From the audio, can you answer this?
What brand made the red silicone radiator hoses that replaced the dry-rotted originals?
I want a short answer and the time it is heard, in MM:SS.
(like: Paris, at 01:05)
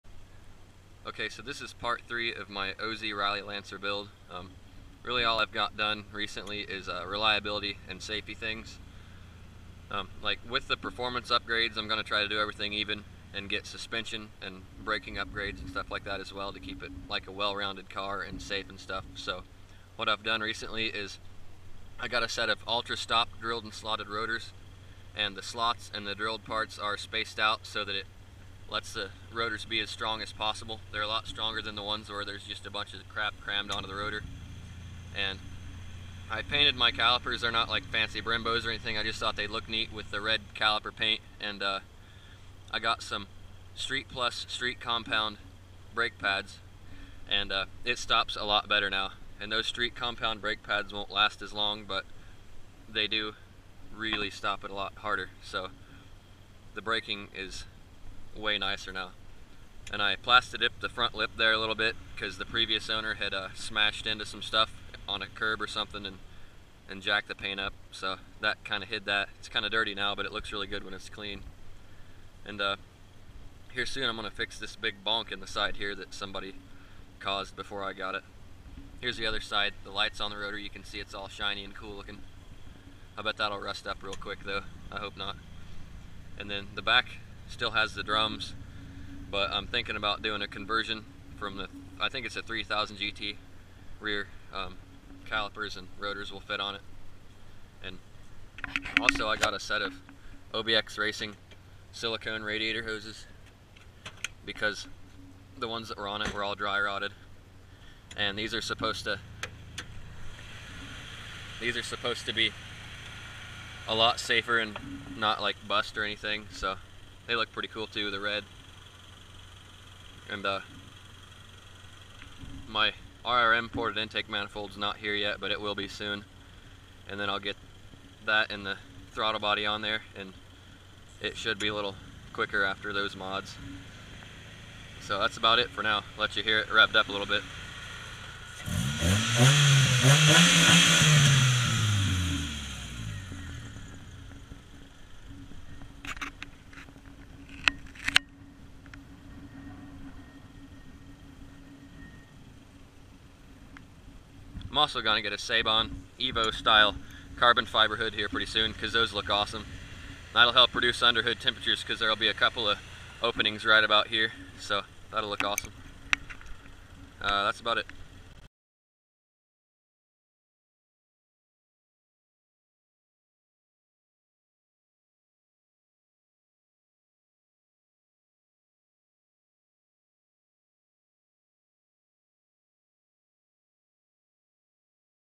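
OBX Racing, at 01:40.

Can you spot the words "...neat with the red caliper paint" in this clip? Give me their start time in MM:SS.
00:39.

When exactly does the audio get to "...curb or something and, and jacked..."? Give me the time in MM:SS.
01:05.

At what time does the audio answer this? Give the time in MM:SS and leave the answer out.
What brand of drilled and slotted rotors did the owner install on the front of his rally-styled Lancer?
00:22.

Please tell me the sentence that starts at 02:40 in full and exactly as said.
That'll help reduce underhood temperatures because there'll be a couple of openings right about here.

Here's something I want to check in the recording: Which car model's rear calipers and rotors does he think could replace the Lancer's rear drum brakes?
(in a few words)
3000 GT.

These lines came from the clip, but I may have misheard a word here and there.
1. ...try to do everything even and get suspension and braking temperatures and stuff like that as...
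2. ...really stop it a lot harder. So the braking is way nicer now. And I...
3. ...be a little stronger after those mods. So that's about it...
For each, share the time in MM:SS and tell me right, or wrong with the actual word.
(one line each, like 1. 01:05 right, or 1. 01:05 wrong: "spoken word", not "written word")
1. 00:12 wrong: "upgrades", not "temperatures"
2. 00:53 right
3. 02:11 wrong: "quicker", not "stronger".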